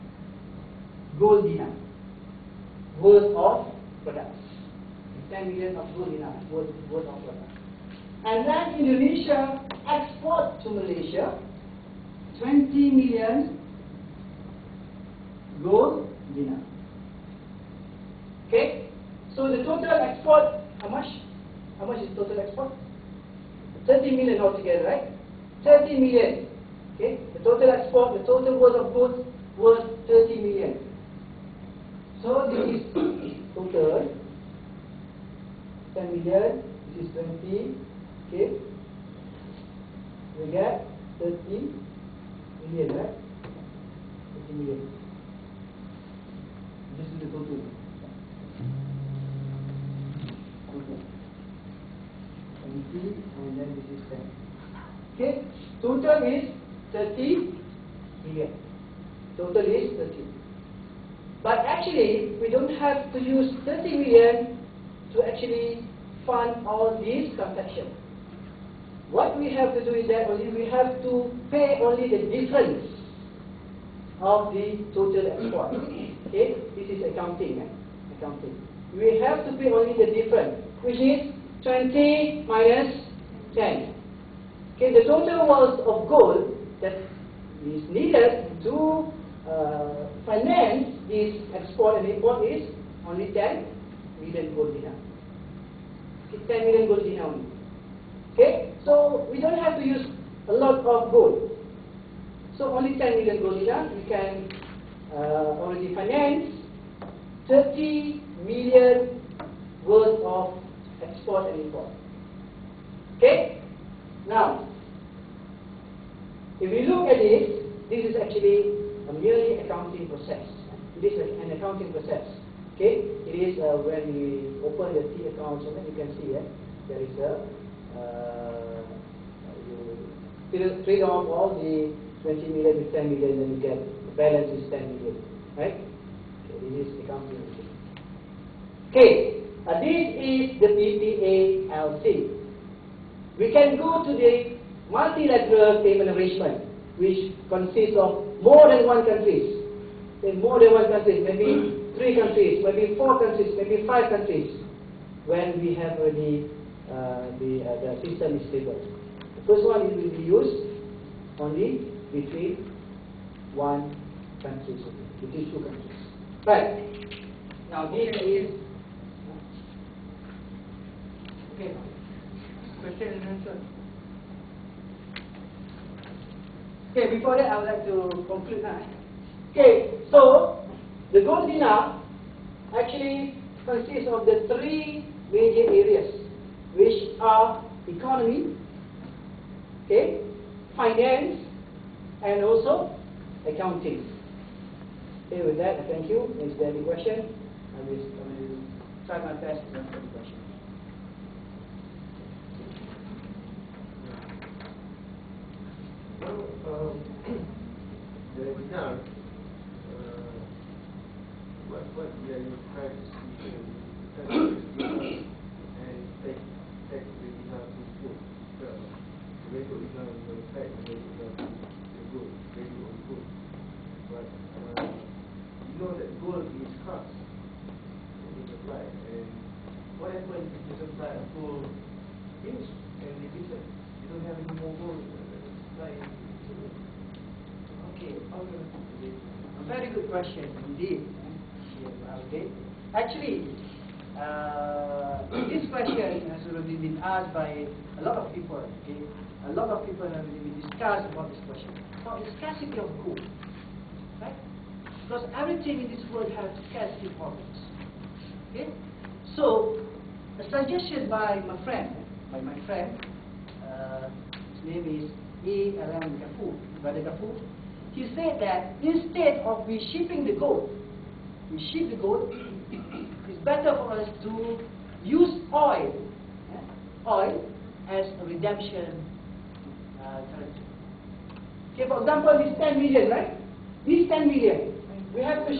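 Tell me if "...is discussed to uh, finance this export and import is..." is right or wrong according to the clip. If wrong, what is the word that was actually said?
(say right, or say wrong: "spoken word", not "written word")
wrong: "needed", not "discussed".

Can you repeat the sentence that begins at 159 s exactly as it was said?
The first one it will be used only between one country, between two countries.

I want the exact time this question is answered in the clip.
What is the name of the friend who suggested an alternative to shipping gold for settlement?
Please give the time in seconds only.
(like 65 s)
265 s.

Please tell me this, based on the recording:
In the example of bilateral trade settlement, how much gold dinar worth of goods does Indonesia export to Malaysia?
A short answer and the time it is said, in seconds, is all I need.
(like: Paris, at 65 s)
20 million, at 12 s.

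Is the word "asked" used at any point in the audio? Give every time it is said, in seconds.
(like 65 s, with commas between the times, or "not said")
247 s.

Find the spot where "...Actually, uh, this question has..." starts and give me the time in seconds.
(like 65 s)
242 s.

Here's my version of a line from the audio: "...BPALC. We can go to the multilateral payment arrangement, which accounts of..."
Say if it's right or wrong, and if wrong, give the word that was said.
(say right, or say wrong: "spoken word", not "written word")
wrong: "consists", not "accounts".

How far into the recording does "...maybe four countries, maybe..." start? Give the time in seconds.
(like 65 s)
152 s.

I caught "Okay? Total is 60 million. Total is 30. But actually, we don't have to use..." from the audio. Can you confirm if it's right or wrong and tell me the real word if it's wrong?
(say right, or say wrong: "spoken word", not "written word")
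wrong: "30", not "60".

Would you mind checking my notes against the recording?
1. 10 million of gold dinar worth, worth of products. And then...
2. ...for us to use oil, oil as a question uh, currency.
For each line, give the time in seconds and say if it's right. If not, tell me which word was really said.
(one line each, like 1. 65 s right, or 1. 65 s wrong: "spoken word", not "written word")
1. 5 s right
2. 273 s wrong: "redemption", not "question".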